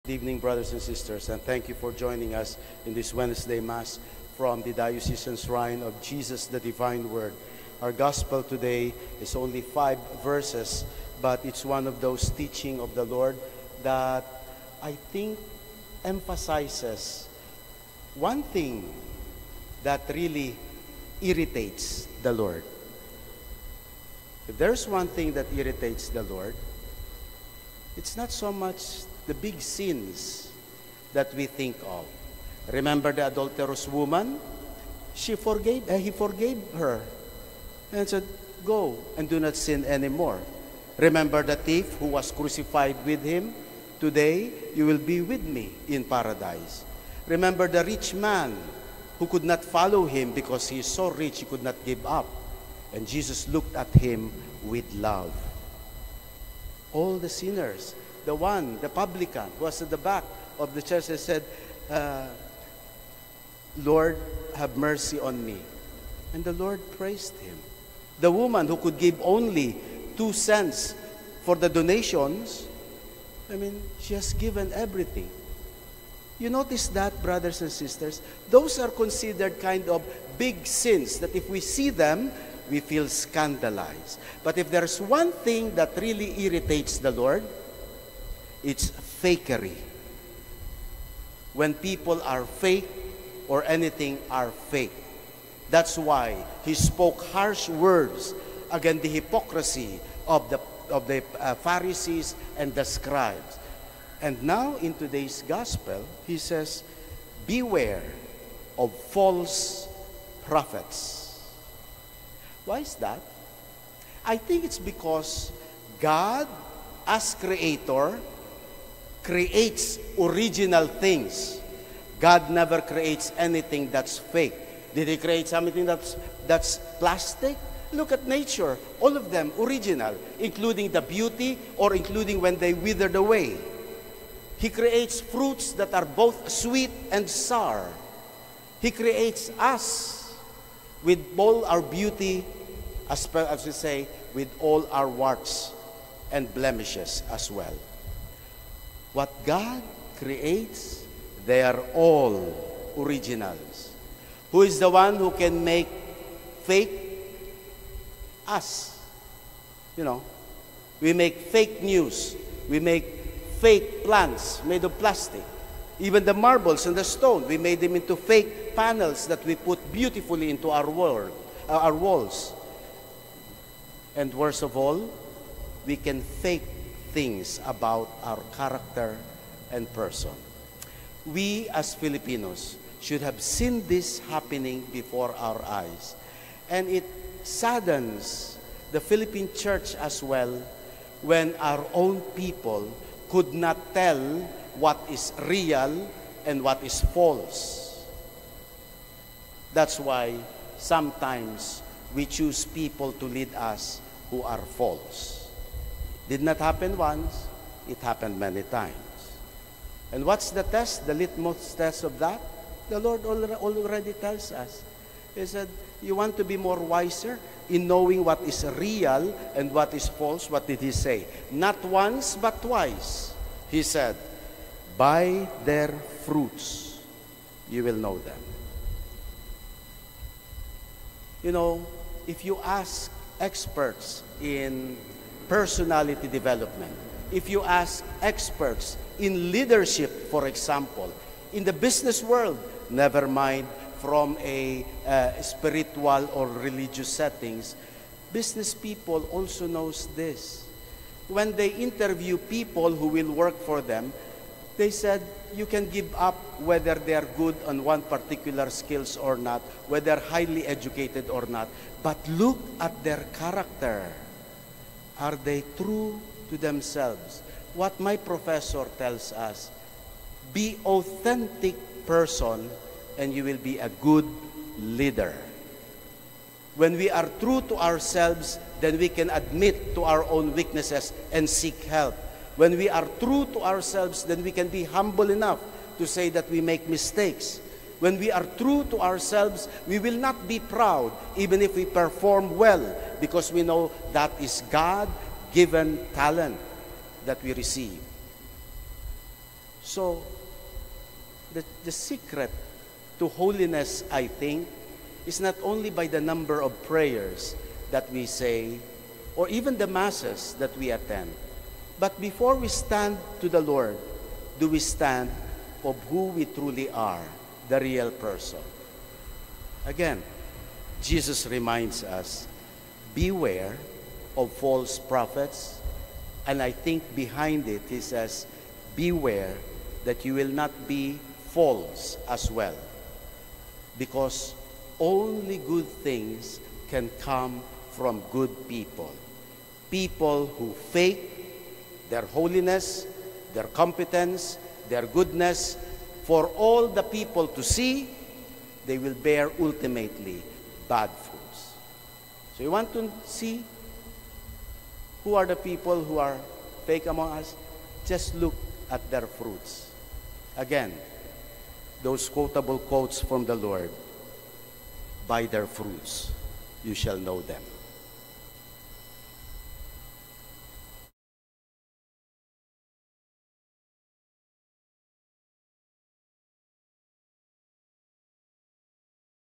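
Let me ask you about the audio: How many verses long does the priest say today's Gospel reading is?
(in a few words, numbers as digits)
5.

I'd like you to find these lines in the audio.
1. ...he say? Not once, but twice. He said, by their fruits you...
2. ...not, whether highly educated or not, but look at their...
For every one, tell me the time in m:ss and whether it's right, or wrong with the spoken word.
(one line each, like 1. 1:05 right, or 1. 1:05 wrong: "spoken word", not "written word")
1. 3:40 right
2. 4:19 right.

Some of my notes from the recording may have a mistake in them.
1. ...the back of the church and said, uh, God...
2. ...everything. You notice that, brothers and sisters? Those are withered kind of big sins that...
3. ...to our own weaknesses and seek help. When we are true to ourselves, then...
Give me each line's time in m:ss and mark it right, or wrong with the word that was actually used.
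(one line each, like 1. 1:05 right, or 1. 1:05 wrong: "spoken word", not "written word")
1. 0:59 wrong: "Lord", not "God"
2. 1:14 wrong: "considered", not "withered"
3. 4:39 right.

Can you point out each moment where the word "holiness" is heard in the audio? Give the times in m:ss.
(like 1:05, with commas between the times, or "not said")
5:03, 5:42.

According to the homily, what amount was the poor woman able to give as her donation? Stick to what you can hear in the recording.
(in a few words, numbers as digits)
two cents.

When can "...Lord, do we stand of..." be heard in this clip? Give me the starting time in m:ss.
5:13.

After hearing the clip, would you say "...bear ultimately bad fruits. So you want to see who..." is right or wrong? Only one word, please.
right.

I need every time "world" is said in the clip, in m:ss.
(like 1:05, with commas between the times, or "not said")
2:50, 4:02.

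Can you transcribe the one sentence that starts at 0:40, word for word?
Remember the thief who was crucified with him?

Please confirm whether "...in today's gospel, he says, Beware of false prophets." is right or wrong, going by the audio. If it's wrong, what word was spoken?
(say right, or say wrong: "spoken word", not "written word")
right.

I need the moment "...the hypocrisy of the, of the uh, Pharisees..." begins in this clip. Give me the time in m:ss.
1:39.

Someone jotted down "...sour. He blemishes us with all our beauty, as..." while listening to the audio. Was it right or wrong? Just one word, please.
wrong.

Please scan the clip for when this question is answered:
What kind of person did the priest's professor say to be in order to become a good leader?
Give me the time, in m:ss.
4:30.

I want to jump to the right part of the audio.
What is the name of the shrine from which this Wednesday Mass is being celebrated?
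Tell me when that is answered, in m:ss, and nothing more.
0:04.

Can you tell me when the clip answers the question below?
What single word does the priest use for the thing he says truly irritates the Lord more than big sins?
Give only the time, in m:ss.
1:29.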